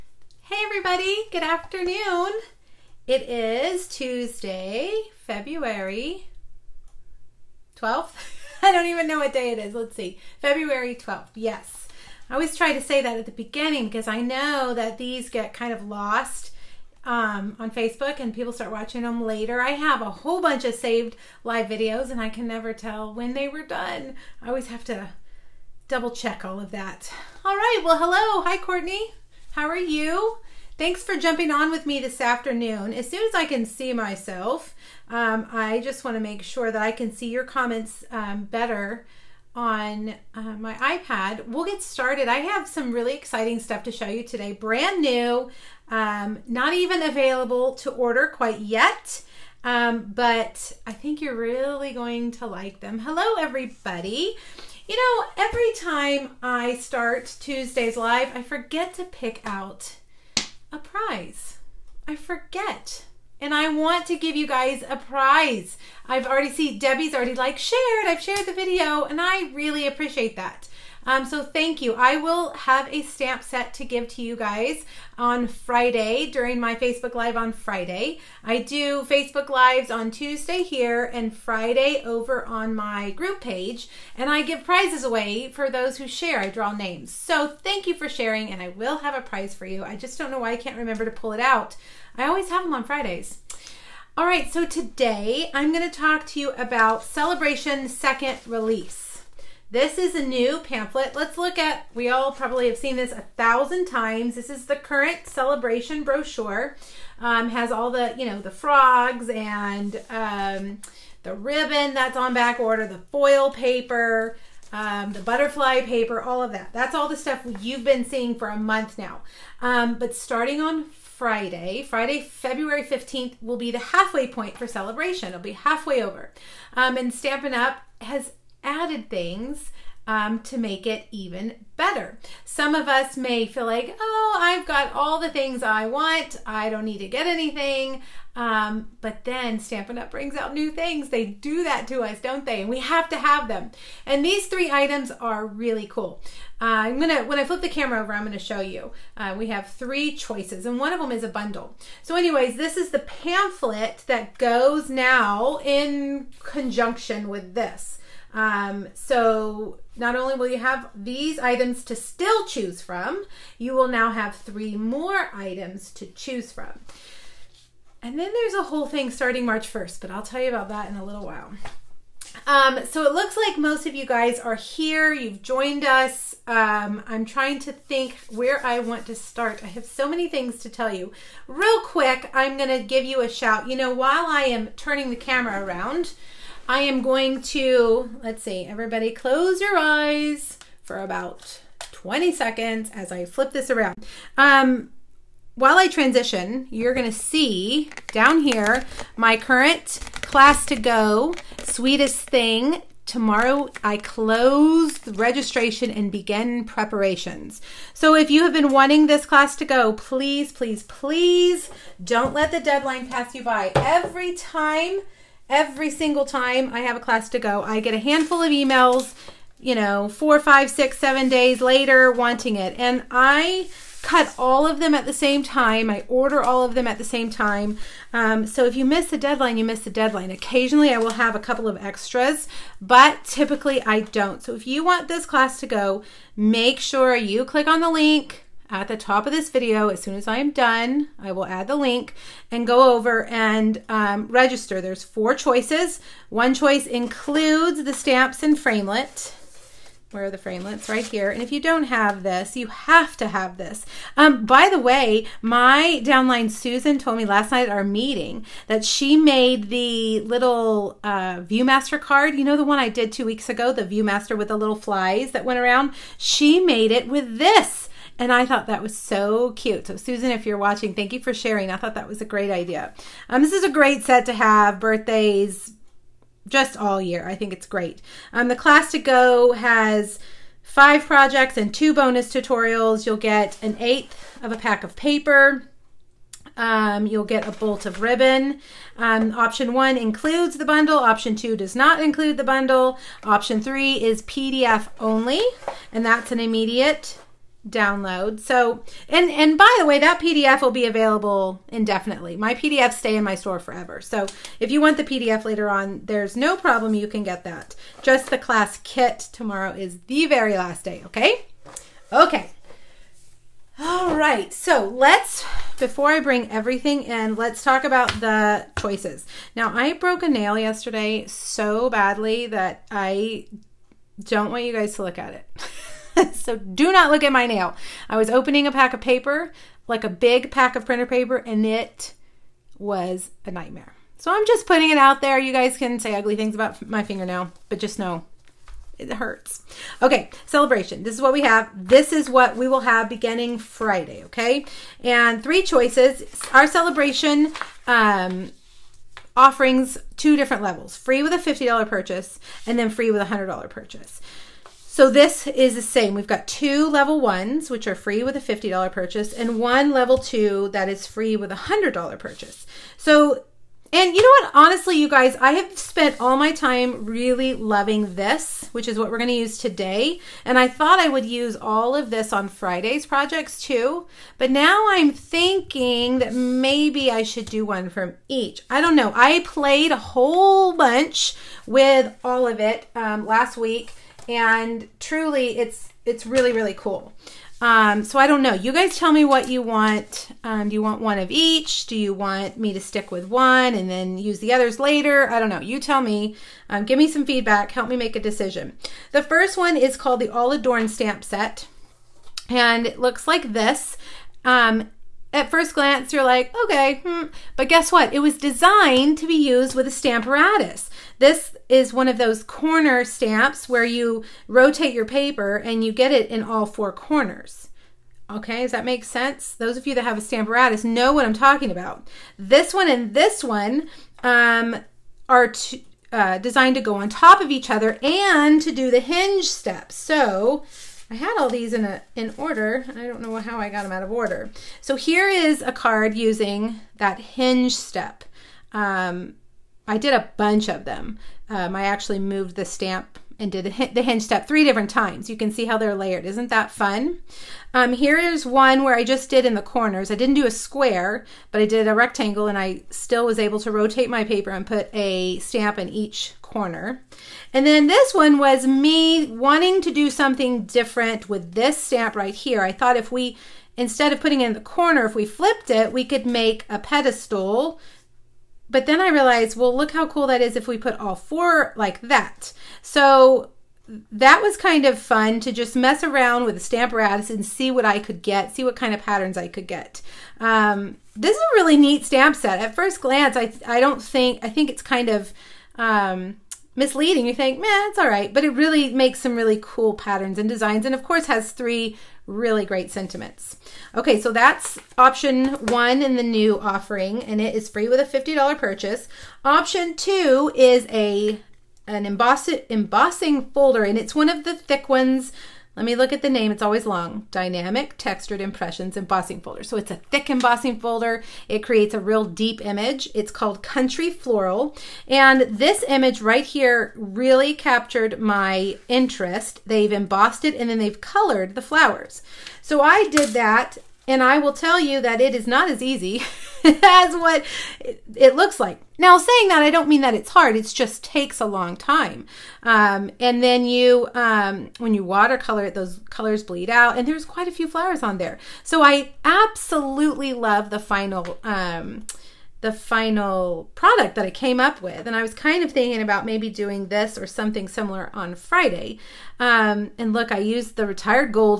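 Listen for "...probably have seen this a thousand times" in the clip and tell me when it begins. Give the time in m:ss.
1:42.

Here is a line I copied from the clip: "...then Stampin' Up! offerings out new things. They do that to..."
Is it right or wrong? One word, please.
wrong.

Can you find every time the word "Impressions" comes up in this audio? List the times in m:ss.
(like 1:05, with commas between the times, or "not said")
8:28.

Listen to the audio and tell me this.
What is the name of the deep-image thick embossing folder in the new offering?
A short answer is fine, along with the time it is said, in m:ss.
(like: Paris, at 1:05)
Country Floral, at 8:33.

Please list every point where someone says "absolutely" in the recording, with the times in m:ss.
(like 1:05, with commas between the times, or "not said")
8:59.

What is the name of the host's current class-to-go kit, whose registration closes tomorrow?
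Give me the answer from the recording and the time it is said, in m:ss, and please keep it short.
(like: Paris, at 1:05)
Sweetest Thing, at 3:21.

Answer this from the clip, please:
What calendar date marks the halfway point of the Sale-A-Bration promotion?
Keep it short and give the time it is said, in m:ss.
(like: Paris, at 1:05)
February 15th, at 2:02.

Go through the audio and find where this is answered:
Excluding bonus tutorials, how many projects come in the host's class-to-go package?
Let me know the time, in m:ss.
4:40.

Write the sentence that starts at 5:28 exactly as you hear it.
I was opening a pack of paper, like a big pack of printer paper, and it was a nightmare.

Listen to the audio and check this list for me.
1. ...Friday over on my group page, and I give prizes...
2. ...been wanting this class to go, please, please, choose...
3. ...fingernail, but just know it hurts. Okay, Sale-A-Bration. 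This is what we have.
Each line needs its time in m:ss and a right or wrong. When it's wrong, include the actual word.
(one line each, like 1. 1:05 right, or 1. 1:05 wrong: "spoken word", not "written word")
1. 1:21 right
2. 3:28 wrong: "please", not "choose"
3. 5:37 right.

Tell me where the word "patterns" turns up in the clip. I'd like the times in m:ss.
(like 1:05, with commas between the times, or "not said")
7:59, 8:09.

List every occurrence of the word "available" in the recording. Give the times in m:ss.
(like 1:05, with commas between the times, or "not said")
0:47, 5:00.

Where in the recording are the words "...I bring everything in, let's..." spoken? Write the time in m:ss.
5:16.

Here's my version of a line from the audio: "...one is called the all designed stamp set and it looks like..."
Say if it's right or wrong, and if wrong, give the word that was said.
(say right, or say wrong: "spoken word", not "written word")
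wrong: "adorned", not "designed".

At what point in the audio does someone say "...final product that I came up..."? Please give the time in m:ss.
9:02.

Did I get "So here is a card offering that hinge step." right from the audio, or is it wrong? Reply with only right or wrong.
wrong.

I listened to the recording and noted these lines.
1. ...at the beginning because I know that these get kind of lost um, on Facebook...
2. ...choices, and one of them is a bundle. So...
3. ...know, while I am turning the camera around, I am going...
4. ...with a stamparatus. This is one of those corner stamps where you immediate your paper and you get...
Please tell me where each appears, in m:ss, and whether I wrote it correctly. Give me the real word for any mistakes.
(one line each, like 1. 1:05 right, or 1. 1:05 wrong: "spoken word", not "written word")
1. 0:13 right
2. 2:30 right
3. 3:03 right
4. 6:49 wrong: "rotate", not "immediate".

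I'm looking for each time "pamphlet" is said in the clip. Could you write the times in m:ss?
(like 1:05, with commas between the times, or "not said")
1:40, 2:32.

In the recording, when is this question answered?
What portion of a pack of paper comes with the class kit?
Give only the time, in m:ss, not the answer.
4:43.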